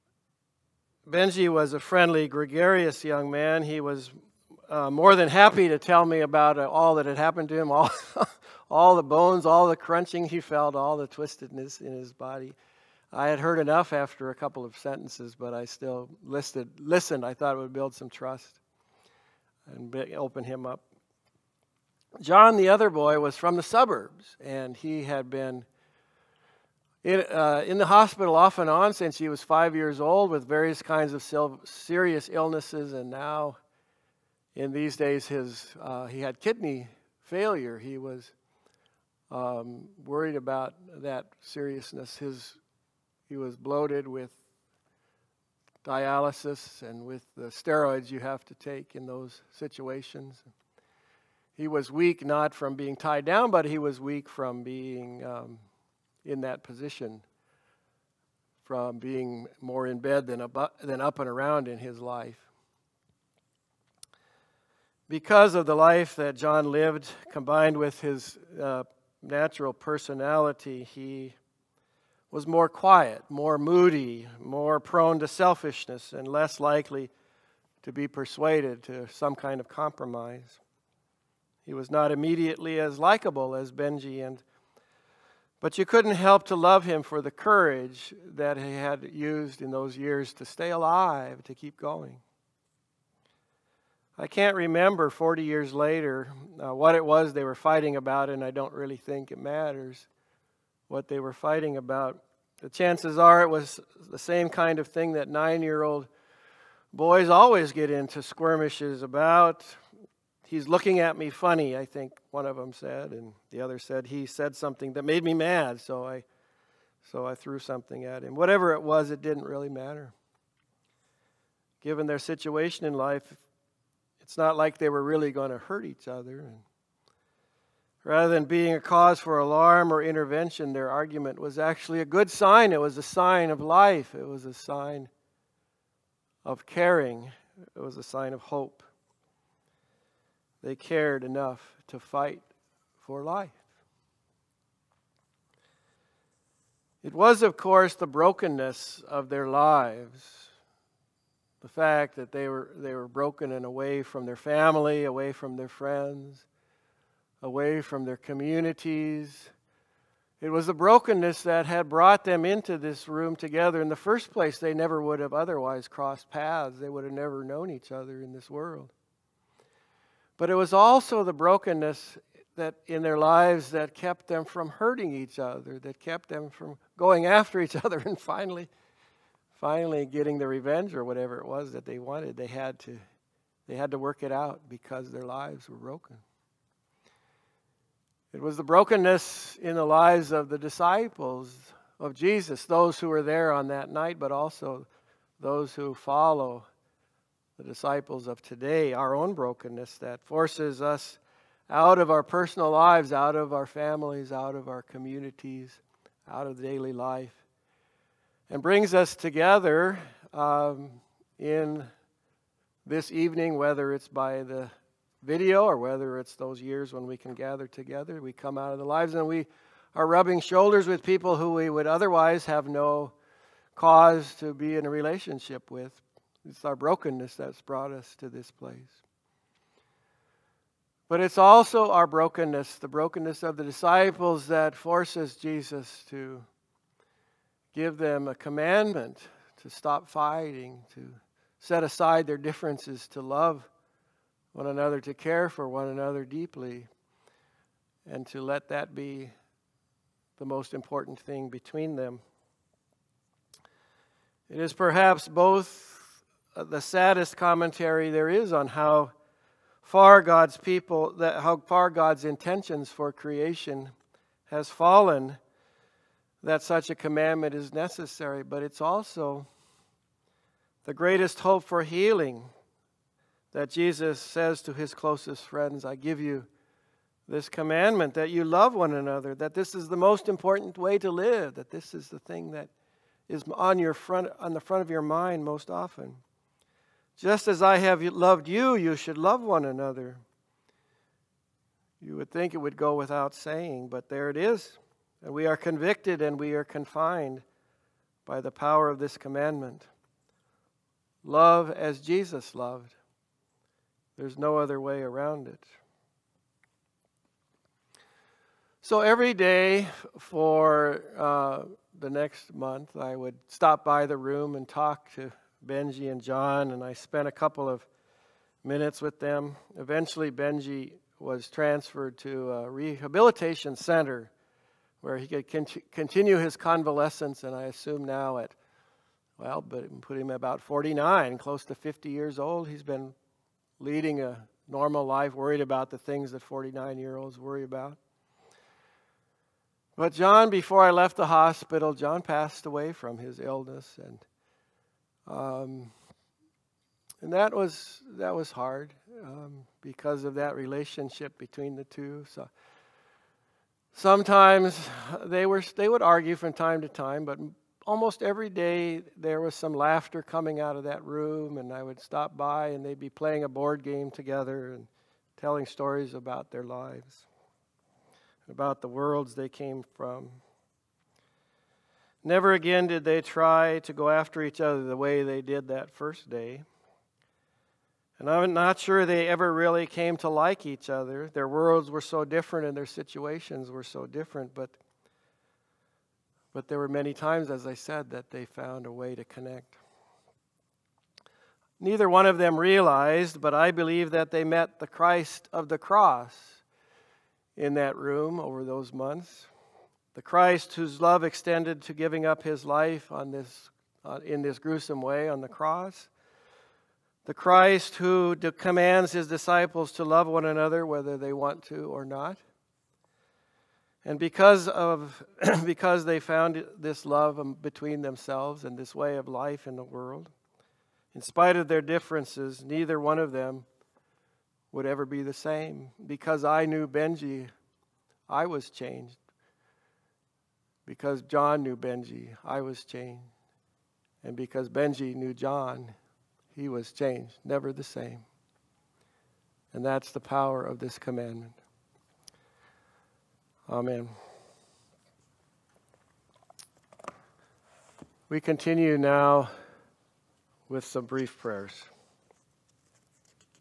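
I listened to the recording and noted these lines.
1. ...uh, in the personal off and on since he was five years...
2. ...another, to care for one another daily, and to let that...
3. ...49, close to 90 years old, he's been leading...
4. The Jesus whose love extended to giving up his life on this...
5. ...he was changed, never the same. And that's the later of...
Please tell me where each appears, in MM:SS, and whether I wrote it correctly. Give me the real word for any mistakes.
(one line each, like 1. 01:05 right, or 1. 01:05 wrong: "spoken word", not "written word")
1. 00:27 wrong: "hospital", not "personal"
2. 04:04 wrong: "deeply", not "daily"
3. 05:30 wrong: "50", not "90"
4. 06:40 wrong: "Christ", not "Jesus"
5. 07:16 wrong: "power", not "later".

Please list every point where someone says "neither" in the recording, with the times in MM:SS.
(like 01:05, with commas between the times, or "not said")
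06:31, 07:02.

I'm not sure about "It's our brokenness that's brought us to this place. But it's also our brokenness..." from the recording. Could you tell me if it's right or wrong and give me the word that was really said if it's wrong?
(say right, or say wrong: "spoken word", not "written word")
right.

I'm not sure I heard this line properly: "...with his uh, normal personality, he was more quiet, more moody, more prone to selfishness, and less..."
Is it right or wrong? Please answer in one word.
wrong.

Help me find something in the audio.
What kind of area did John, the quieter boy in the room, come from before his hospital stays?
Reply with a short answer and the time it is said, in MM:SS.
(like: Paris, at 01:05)
the suburbs, at 00:23.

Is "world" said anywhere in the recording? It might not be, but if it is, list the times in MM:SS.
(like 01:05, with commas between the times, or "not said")
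02:48, 06:08, 06:21, 06:59.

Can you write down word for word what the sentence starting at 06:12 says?
Never again did they try to go after each other the way they did that first day.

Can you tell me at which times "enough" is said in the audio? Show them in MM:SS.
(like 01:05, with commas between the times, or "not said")
00:13, 02:21.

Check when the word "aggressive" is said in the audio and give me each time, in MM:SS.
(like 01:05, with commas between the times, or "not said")
not said.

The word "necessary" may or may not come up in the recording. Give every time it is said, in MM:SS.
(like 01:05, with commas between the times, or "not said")
04:27.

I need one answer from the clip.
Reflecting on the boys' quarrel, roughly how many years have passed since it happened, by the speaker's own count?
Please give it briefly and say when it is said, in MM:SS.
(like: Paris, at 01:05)
40 years, at 01:35.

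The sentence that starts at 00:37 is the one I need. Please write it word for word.
He was um, worried about that seriousness.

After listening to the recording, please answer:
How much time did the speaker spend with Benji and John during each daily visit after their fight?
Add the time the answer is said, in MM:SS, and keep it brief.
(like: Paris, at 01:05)
a couple of minutes, at 05:17.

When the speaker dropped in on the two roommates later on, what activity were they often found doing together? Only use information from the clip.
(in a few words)
playing a board game.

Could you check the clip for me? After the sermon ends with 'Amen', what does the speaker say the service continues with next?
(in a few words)
brief prayers.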